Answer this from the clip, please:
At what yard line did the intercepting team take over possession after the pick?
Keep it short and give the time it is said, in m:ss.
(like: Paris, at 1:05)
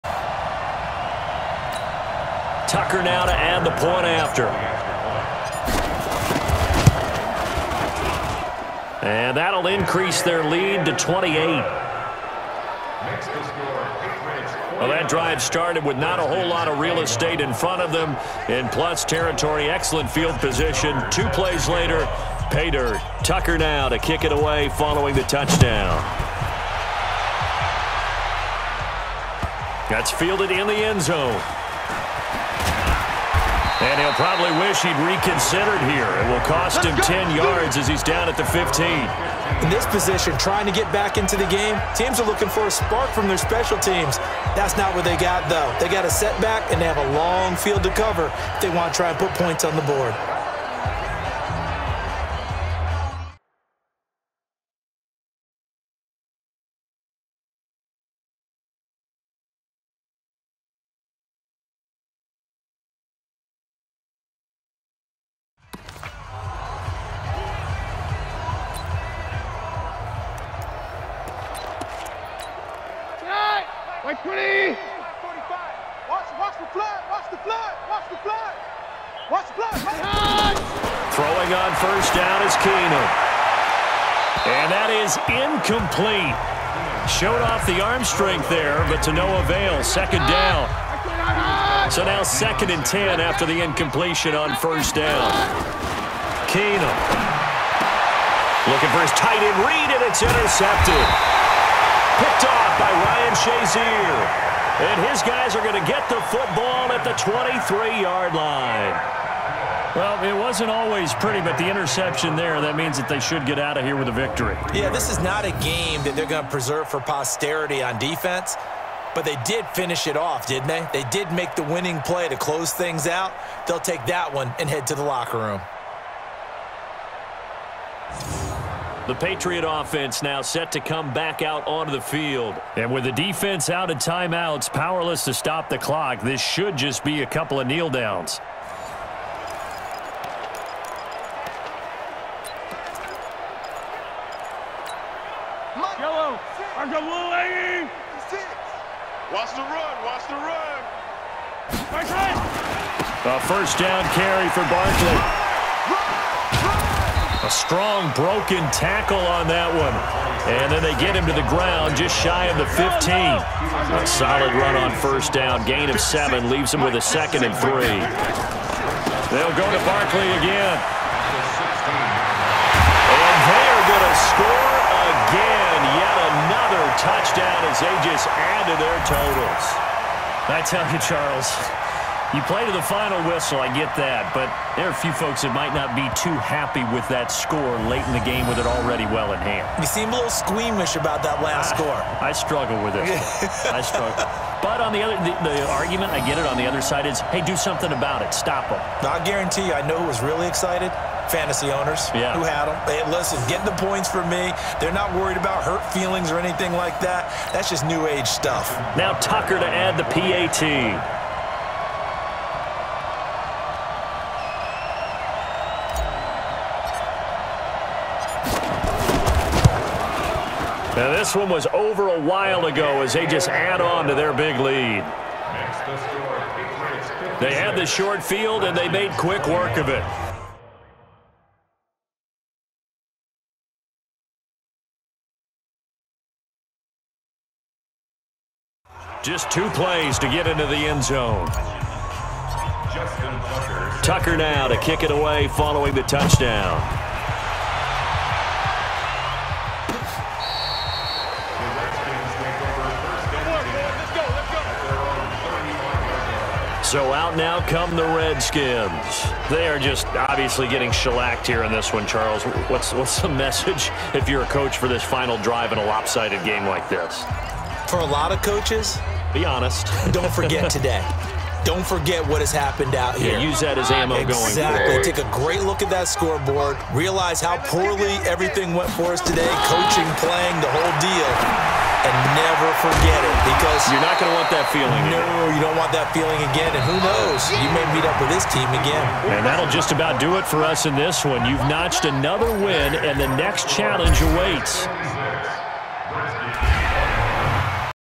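23-yard line, at 1:47.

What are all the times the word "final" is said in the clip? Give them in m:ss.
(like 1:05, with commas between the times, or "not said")
3:02, 4:25.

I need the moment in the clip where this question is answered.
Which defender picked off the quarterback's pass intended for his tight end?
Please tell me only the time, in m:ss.
1:43.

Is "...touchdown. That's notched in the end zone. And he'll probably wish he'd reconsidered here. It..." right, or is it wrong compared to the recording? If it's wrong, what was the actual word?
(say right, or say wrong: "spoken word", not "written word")
wrong: "fielded", not "notched".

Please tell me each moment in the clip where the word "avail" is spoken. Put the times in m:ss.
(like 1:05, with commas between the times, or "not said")
1:29.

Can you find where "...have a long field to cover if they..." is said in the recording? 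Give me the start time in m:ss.
0:46.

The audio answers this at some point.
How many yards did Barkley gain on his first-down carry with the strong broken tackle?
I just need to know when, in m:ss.
2:45.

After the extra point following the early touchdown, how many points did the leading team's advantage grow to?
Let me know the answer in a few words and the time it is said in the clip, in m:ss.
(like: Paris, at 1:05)
28, at 0:10.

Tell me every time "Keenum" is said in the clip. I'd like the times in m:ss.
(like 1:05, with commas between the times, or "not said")
1:22, 1:36.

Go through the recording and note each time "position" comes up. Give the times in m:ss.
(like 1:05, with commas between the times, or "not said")
0:20, 0:39.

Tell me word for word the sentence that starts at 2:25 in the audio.
Yellow, Watch the run, watch the run!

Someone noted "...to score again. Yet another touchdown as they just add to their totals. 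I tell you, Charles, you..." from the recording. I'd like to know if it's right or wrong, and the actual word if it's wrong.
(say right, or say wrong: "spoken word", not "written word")
right.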